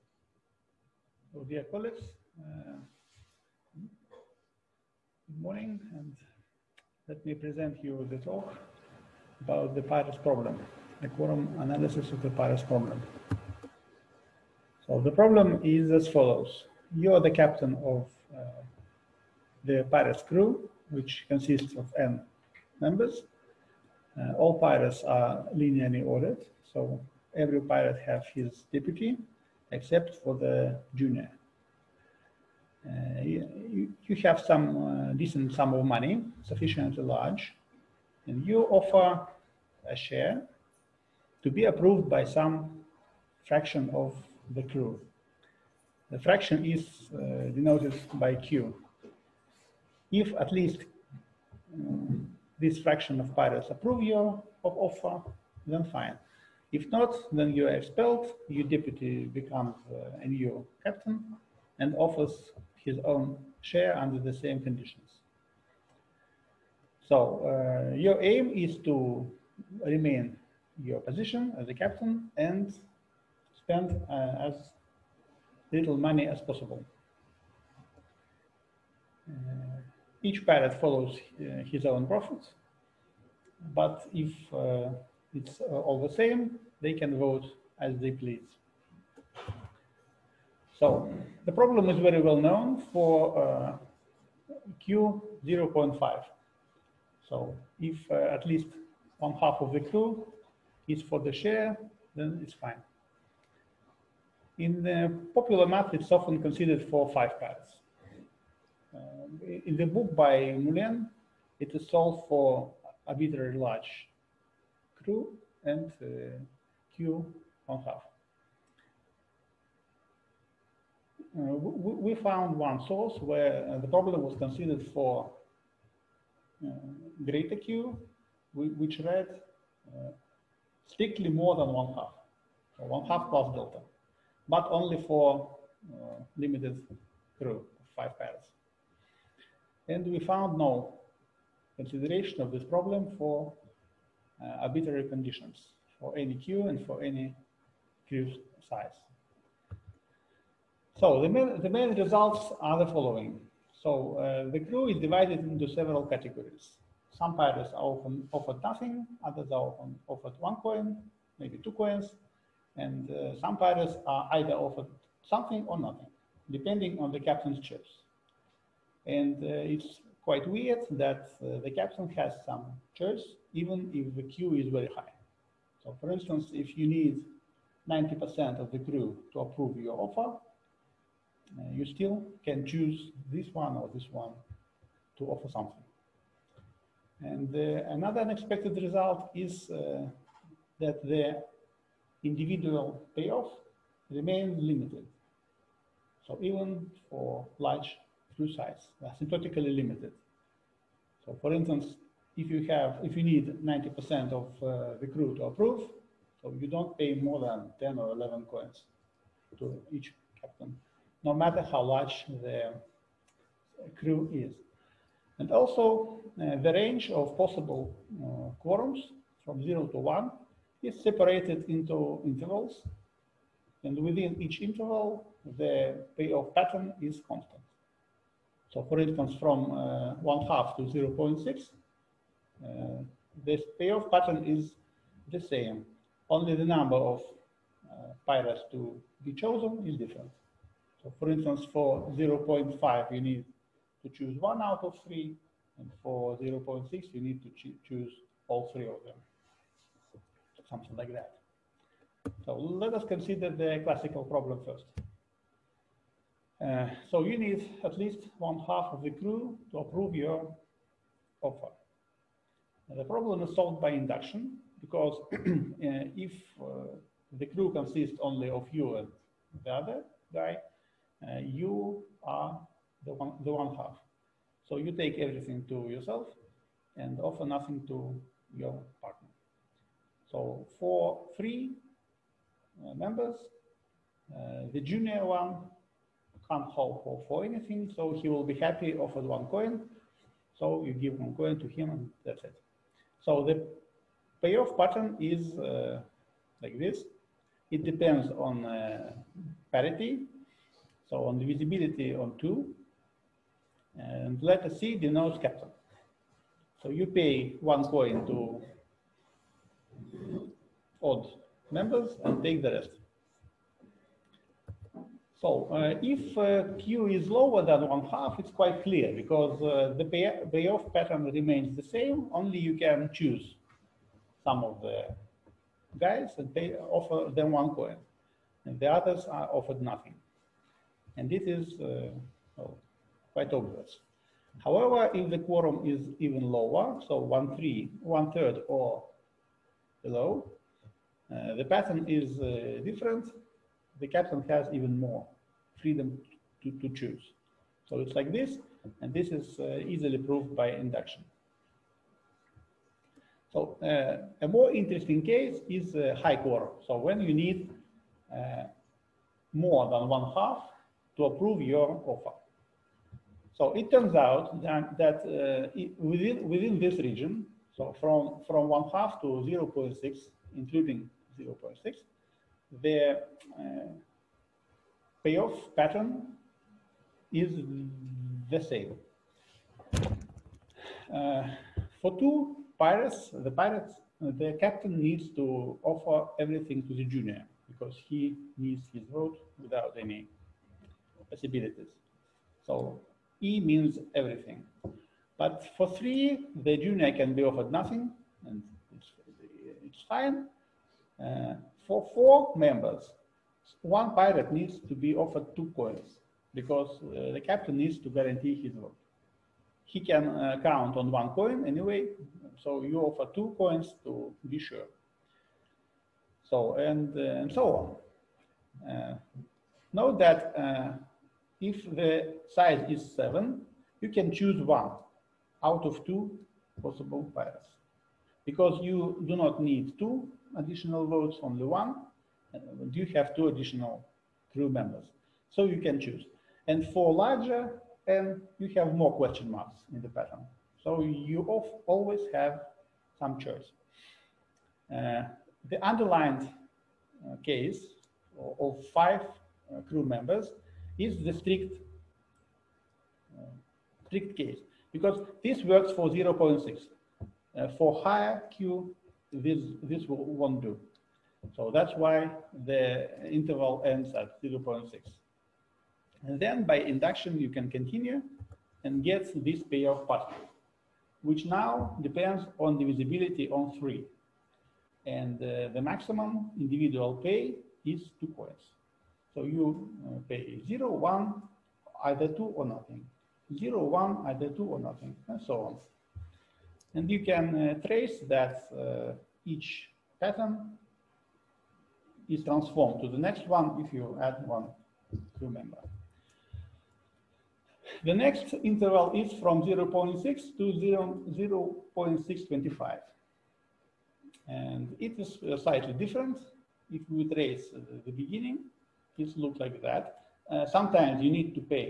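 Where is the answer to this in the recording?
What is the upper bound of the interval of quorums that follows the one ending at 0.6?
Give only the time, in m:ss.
8:21.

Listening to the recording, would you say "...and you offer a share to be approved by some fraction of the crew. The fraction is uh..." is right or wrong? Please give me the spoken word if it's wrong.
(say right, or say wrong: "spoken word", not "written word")
right.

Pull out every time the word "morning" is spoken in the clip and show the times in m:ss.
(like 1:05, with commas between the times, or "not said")
0:05.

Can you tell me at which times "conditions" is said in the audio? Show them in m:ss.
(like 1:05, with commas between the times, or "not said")
1:04, 2:25.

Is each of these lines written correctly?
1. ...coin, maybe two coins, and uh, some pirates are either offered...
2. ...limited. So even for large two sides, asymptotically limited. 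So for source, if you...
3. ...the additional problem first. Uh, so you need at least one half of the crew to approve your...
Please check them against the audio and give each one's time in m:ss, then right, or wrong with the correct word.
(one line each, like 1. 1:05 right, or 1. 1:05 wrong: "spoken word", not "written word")
1. 2:40 right
2. 3:14 wrong: "instance", not "source"
3. 4:13 wrong: "classical", not "additional".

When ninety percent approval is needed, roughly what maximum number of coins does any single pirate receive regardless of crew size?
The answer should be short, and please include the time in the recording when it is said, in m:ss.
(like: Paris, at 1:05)
10 or 11, at 3:27.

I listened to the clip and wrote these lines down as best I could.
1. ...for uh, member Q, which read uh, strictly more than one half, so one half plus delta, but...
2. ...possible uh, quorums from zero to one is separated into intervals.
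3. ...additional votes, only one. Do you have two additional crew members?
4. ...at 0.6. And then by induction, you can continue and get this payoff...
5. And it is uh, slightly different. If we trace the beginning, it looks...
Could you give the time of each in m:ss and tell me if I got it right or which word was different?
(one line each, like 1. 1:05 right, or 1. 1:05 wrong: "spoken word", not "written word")
1. 2:04 wrong: "greater", not "member"
2. 3:37 right
3. 7:10 right
4. 7:44 right
5. 8:24 right.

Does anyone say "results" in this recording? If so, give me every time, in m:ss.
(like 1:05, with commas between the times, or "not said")
2:31, 3:08.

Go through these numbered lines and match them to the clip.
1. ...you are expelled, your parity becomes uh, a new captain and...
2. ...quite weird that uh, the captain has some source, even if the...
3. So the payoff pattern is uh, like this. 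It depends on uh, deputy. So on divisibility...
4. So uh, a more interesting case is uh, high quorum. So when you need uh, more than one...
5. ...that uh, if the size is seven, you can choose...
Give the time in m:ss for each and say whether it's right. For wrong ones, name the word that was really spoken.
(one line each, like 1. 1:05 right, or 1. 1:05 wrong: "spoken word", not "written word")
1. 0:57 wrong: "deputy", not "parity"
2. 2:50 wrong: "choice", not "source"
3. 4:53 wrong: "parity", not "deputy"
4. 5:53 right
5. 7:00 right.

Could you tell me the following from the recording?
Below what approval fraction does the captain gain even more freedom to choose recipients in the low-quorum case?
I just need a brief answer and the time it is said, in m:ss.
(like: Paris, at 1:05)
one third, at 5:37.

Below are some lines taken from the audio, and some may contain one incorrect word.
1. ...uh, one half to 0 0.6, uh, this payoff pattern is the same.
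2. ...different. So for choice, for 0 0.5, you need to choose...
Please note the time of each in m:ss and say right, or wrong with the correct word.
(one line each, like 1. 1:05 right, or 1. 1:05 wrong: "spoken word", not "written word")
1. 3:49 right
2. 3:59 wrong: "instance", not "choice".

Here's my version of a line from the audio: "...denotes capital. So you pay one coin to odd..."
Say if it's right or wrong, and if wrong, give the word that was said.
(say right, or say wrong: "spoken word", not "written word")
right.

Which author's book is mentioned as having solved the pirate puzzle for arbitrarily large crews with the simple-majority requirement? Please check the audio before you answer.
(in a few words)
Moulin.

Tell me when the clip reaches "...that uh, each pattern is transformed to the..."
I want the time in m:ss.
8:08.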